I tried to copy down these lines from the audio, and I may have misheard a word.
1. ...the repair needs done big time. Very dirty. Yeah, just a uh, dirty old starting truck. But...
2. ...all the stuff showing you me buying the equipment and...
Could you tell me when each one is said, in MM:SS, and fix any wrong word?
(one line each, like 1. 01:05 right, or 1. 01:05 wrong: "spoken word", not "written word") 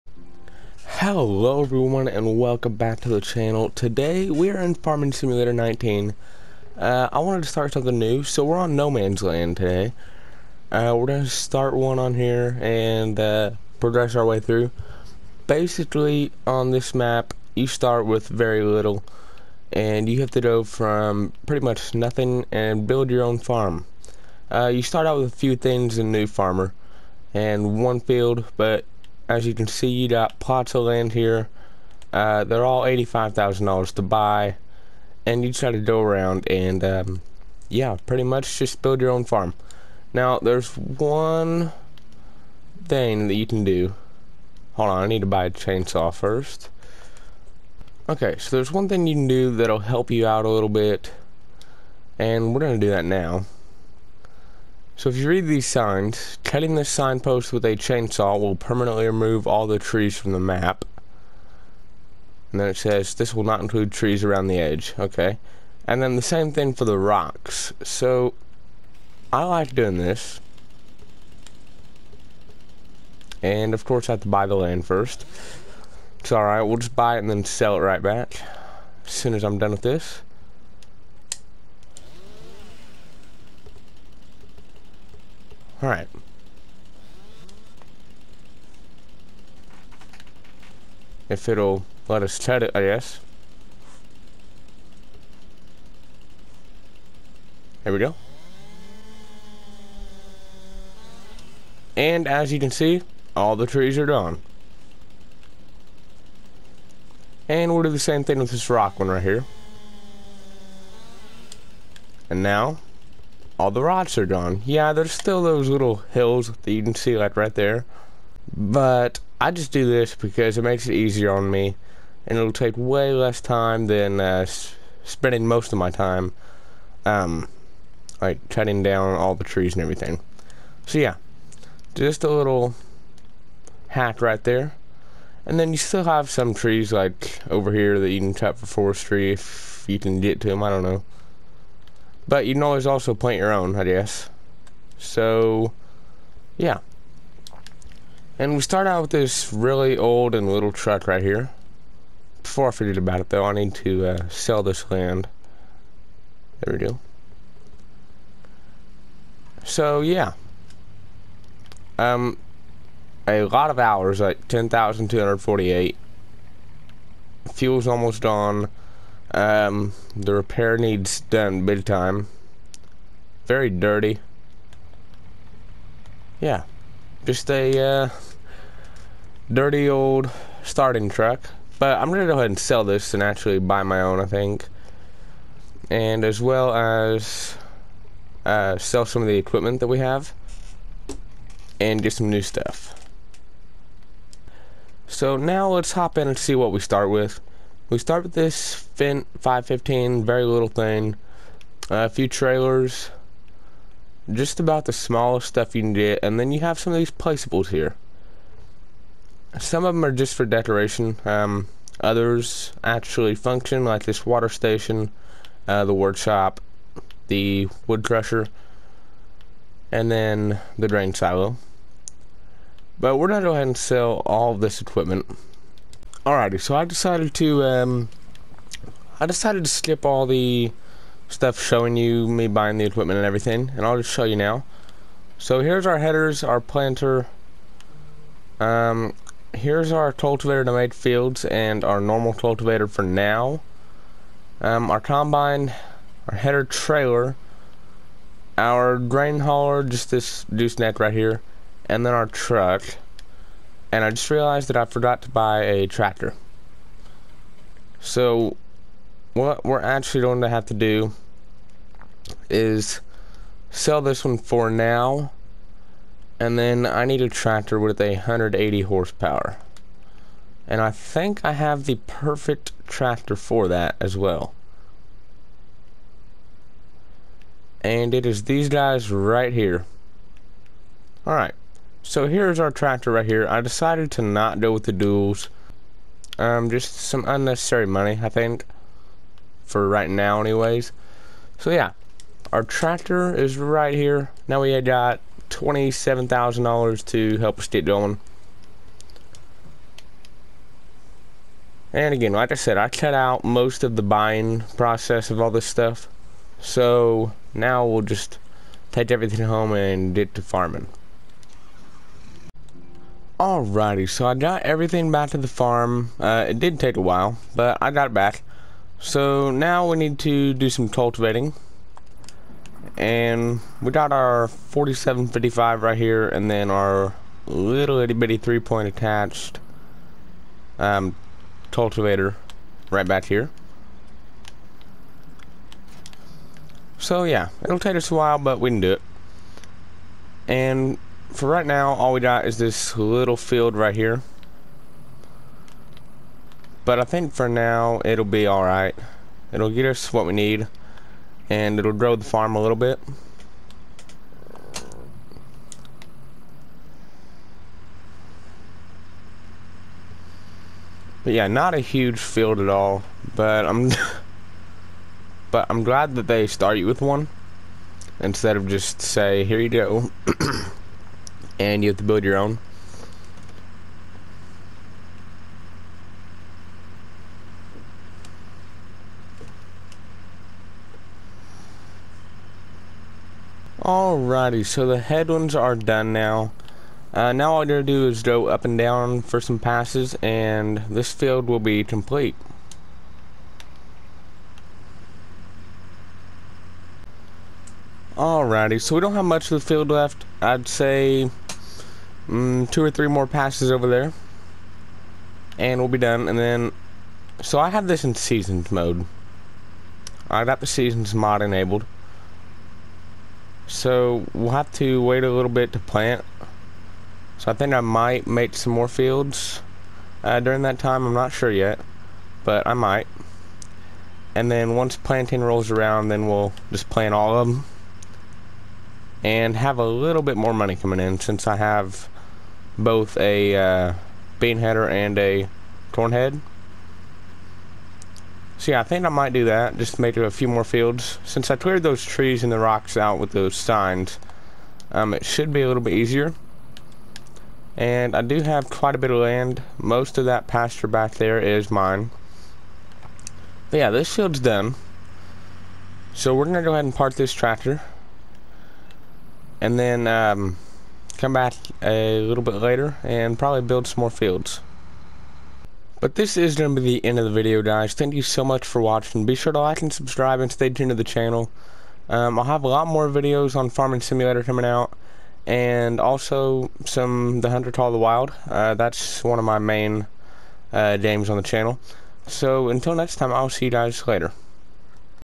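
1. 02:50 right
2. 03:50 right.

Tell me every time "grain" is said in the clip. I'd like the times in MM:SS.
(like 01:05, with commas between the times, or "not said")
03:40, 04:08.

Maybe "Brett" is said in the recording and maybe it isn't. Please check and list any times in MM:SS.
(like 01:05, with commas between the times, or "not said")
not said.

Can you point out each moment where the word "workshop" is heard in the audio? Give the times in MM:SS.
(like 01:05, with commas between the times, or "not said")
03:35.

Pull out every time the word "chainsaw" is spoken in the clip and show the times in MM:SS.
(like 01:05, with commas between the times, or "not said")
00:45, 00:57.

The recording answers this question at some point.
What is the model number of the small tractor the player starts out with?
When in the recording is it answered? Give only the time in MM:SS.
03:18.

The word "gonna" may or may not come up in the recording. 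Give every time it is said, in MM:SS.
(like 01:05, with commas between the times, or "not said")
00:52, 03:02, 06:27.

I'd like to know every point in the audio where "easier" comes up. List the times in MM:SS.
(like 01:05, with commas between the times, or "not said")
02:00, 07:25.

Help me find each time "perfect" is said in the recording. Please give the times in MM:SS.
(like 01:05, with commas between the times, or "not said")
04:32.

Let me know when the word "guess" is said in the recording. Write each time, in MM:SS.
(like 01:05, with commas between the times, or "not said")
01:32, 02:23.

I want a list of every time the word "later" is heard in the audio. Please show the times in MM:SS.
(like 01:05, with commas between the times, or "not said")
07:42, 08:04.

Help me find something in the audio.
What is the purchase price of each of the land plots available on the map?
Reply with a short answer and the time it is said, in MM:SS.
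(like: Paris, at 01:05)
$85,000, at 00:32.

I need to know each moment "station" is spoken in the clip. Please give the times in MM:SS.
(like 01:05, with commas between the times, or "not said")
03:34.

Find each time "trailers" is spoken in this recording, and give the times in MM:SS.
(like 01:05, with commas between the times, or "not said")
03:22, 04:06.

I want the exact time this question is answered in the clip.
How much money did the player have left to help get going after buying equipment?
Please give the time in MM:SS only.
04:55.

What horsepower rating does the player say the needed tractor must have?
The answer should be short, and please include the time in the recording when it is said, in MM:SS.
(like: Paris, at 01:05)
180, at 04:28.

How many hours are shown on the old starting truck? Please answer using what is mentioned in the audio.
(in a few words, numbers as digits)
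10,248.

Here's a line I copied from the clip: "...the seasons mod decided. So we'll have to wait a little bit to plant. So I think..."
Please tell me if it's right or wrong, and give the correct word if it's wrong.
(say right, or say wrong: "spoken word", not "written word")
wrong: "enabled", not "decided".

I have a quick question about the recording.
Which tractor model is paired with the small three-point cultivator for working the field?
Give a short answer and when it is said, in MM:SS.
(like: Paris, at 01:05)
4755, at 05:24.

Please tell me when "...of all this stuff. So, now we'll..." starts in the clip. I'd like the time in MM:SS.
05:05.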